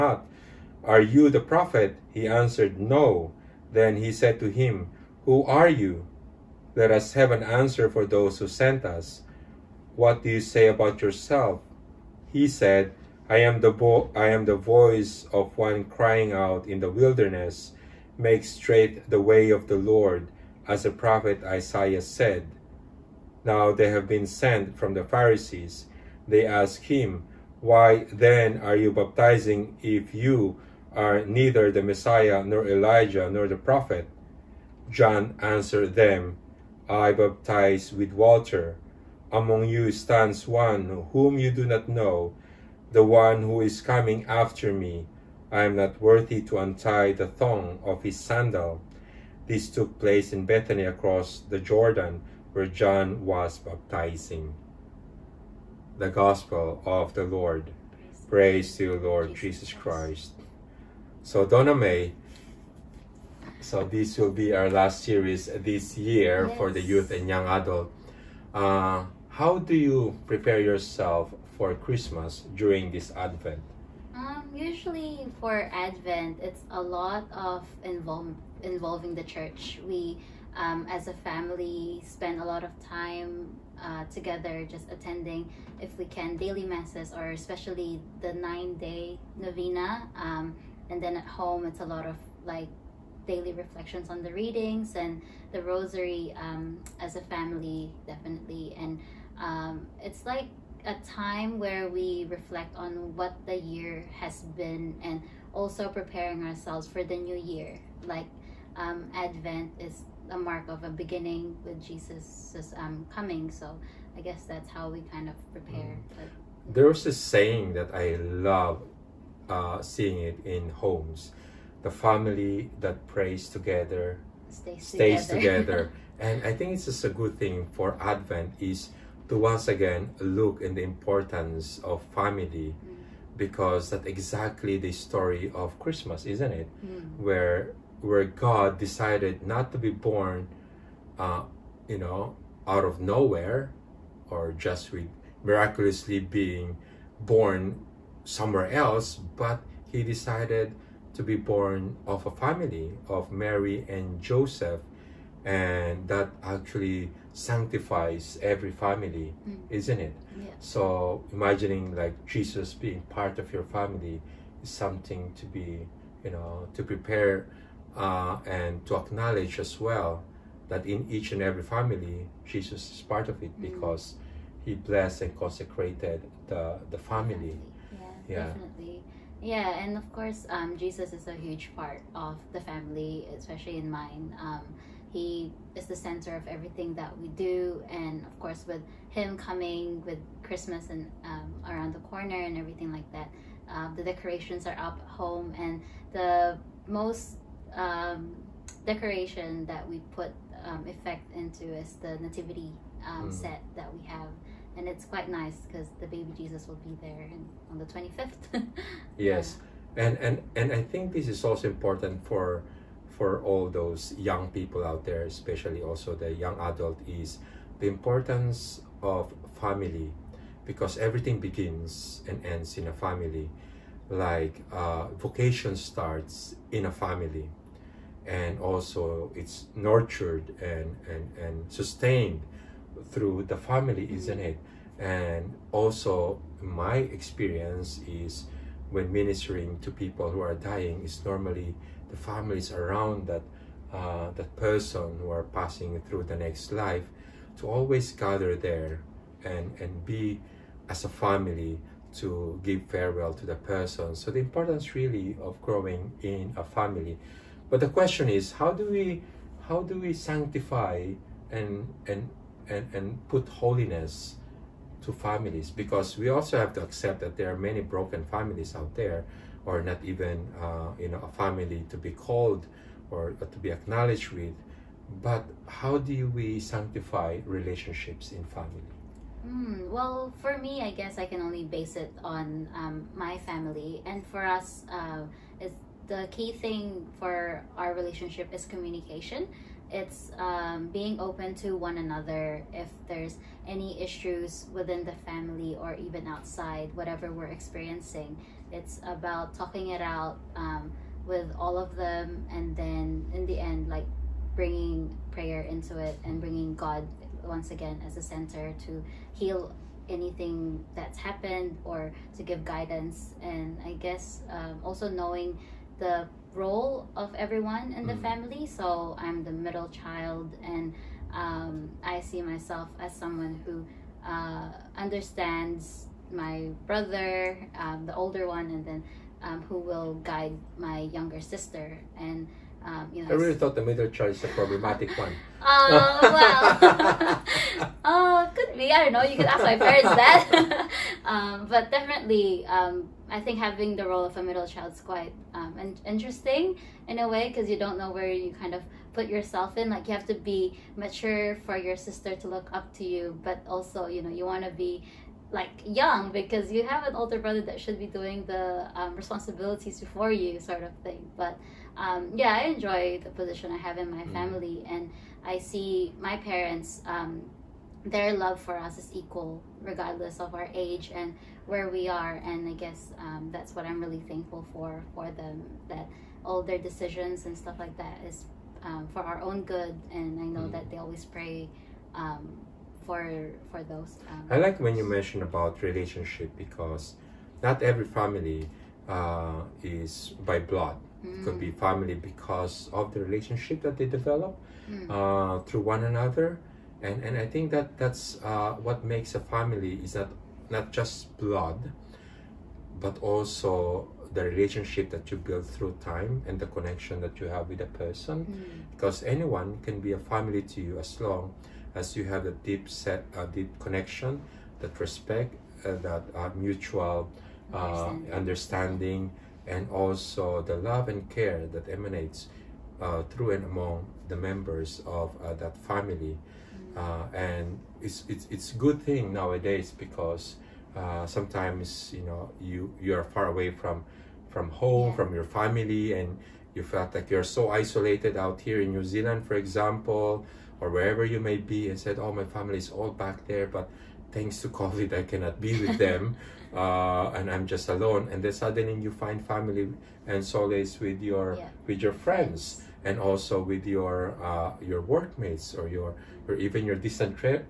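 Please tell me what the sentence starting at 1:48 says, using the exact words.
Like um, Advent is a mark of a beginning with Jesus' um, coming.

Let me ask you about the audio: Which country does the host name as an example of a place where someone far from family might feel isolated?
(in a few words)
New Zealand.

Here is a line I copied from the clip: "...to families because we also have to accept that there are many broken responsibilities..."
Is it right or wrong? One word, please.
wrong.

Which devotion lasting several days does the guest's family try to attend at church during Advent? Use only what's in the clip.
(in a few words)
Nine-day novena.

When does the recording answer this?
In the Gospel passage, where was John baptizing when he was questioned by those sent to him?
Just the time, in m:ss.
0:50.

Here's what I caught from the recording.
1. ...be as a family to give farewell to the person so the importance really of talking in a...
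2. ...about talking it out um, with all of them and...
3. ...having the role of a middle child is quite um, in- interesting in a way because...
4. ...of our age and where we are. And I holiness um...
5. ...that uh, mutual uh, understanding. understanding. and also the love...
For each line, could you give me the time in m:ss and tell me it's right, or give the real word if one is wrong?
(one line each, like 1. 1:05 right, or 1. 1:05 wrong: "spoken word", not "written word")
1. 4:10 wrong: "growing", not "talking"
2. 4:59 right
3. 5:43 right
4. 6:10 wrong: "guess", not "holiness"
5. 6:56 right.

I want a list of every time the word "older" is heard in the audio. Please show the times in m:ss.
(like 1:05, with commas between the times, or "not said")
5:28, 5:57.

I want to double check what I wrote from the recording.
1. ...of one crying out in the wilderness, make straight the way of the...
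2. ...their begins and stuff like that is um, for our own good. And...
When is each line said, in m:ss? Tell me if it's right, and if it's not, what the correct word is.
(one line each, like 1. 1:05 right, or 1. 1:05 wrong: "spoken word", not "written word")
1. 0:15 right
2. 6:16 wrong: "decisions", not "begins".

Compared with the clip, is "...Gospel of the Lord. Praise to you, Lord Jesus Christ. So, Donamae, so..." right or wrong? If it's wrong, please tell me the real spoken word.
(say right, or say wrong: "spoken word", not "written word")
right.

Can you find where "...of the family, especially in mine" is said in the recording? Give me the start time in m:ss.
3:02.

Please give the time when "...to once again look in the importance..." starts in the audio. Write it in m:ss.
2:09.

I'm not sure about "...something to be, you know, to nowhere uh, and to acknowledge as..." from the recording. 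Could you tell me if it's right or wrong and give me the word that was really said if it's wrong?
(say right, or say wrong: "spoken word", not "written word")
wrong: "prepare", not "nowhere".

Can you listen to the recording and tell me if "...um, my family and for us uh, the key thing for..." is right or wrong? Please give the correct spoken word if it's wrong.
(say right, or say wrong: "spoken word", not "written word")
right.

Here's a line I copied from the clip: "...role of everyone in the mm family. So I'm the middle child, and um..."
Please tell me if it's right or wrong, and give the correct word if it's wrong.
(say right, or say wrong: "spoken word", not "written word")
right.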